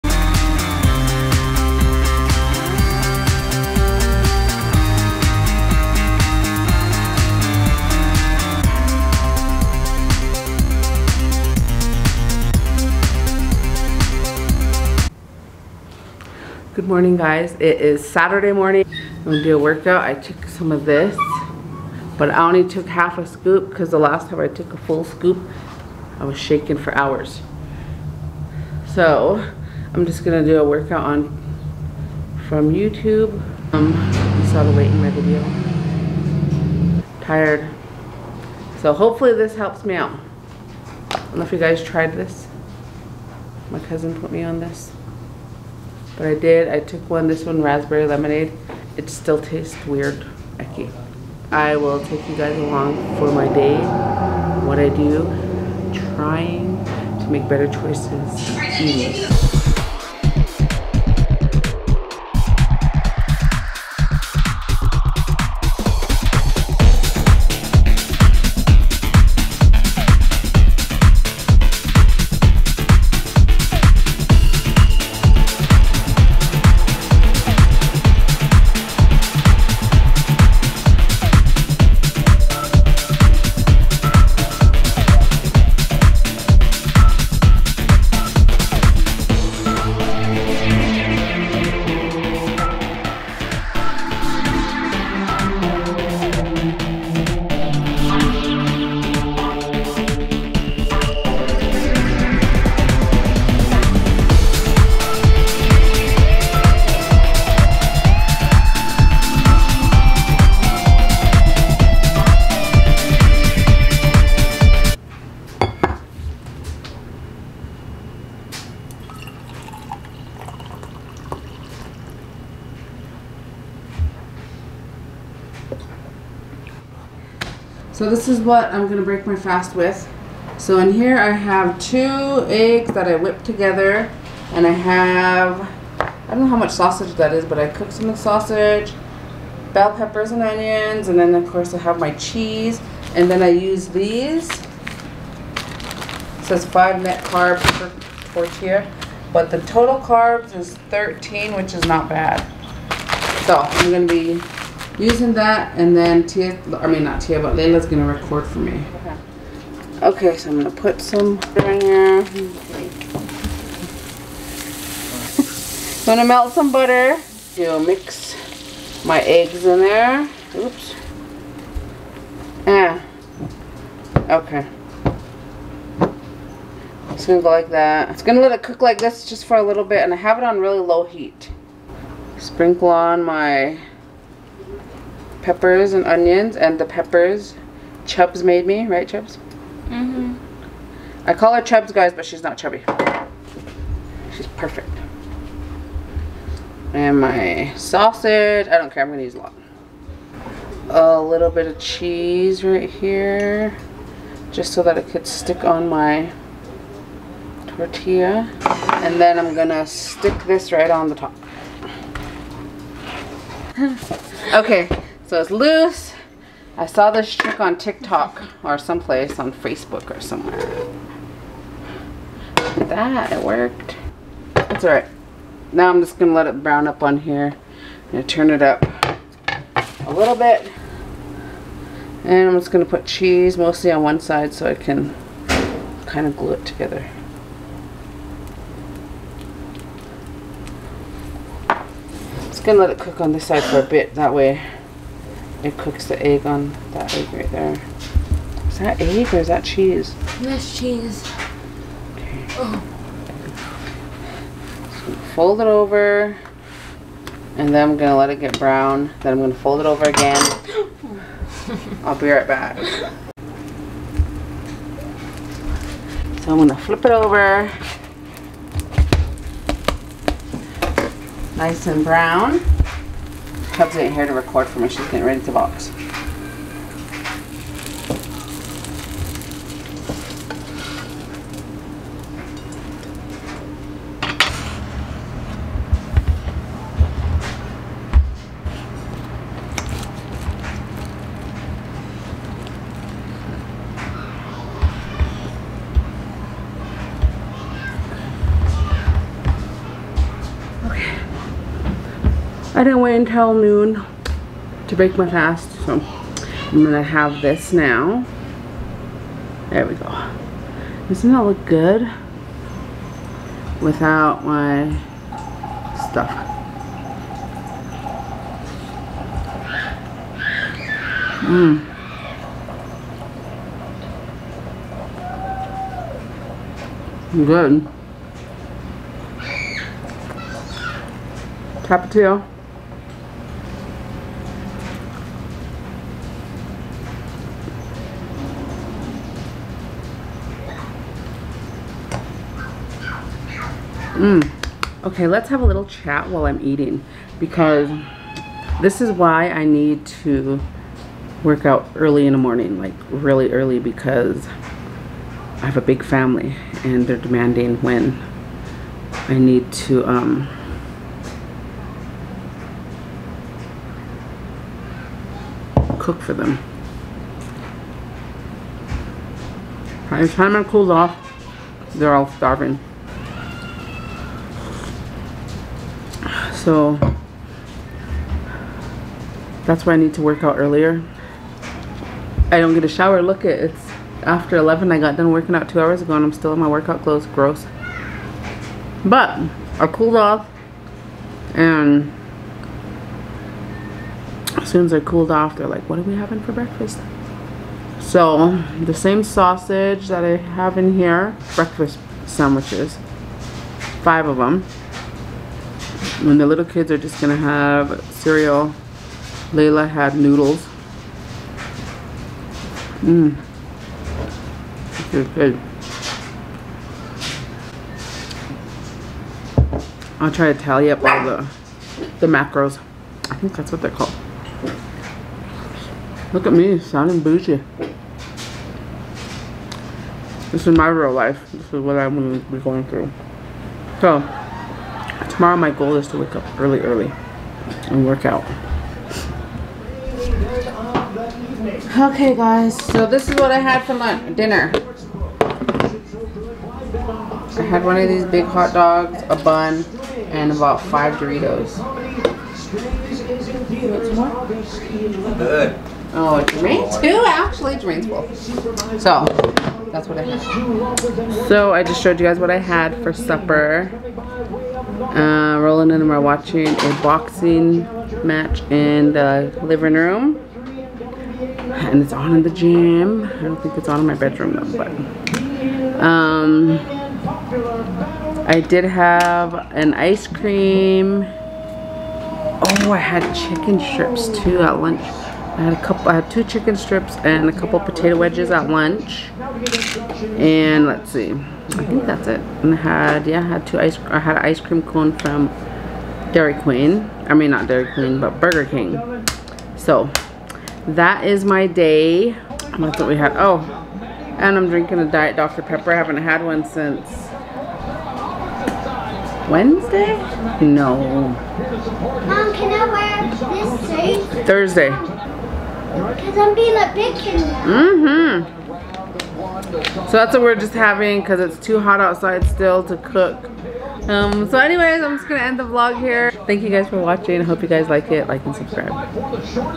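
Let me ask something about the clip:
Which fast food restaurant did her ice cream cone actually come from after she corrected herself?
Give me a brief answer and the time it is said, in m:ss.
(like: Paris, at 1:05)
Burger King, at 8:18.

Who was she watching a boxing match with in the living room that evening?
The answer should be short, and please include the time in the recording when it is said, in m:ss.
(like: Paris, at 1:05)
Roland, at 7:45.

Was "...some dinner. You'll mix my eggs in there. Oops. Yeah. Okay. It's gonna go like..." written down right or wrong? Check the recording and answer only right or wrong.
wrong.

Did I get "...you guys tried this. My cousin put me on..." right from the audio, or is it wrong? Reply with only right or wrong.
right.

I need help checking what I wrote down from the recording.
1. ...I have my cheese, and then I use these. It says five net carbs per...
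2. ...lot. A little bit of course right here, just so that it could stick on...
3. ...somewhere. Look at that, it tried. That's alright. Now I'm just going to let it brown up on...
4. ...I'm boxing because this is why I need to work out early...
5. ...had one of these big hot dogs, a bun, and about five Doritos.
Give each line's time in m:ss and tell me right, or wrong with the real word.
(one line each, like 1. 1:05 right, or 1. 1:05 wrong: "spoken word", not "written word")
1. 2:21 right
2. 3:19 wrong: "cheese", not "course"
3. 3:40 wrong: "worked", not "tried"
4. 5:46 wrong: "eating", not "boxing"
5. 7:27 right.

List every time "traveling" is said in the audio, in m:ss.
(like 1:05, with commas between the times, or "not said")
not said.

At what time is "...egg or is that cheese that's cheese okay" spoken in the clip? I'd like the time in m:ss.
4:09.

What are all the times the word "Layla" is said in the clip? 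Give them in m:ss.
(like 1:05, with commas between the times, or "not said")
2:37, 6:49.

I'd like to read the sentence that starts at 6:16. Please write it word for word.
So that's why I need to work out earlier.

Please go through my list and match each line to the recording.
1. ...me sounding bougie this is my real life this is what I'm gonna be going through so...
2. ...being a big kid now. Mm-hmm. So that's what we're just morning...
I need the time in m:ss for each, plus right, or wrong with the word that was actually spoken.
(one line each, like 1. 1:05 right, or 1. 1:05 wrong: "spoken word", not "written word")
1. 7:06 right
2. 8:36 wrong: "having", not "morning".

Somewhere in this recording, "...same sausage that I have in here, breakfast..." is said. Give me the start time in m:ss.
6:38.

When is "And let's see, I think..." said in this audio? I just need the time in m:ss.
8:10.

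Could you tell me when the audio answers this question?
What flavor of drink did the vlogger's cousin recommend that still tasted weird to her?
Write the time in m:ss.
0:47.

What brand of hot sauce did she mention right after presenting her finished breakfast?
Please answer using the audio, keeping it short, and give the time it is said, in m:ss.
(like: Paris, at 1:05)
Tapatio, at 5:31.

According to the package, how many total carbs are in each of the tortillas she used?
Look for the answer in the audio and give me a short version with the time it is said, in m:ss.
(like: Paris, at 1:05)
13, at 2:30.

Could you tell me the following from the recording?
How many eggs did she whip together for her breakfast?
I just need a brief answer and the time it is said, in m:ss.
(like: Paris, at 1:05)
2, at 2:11.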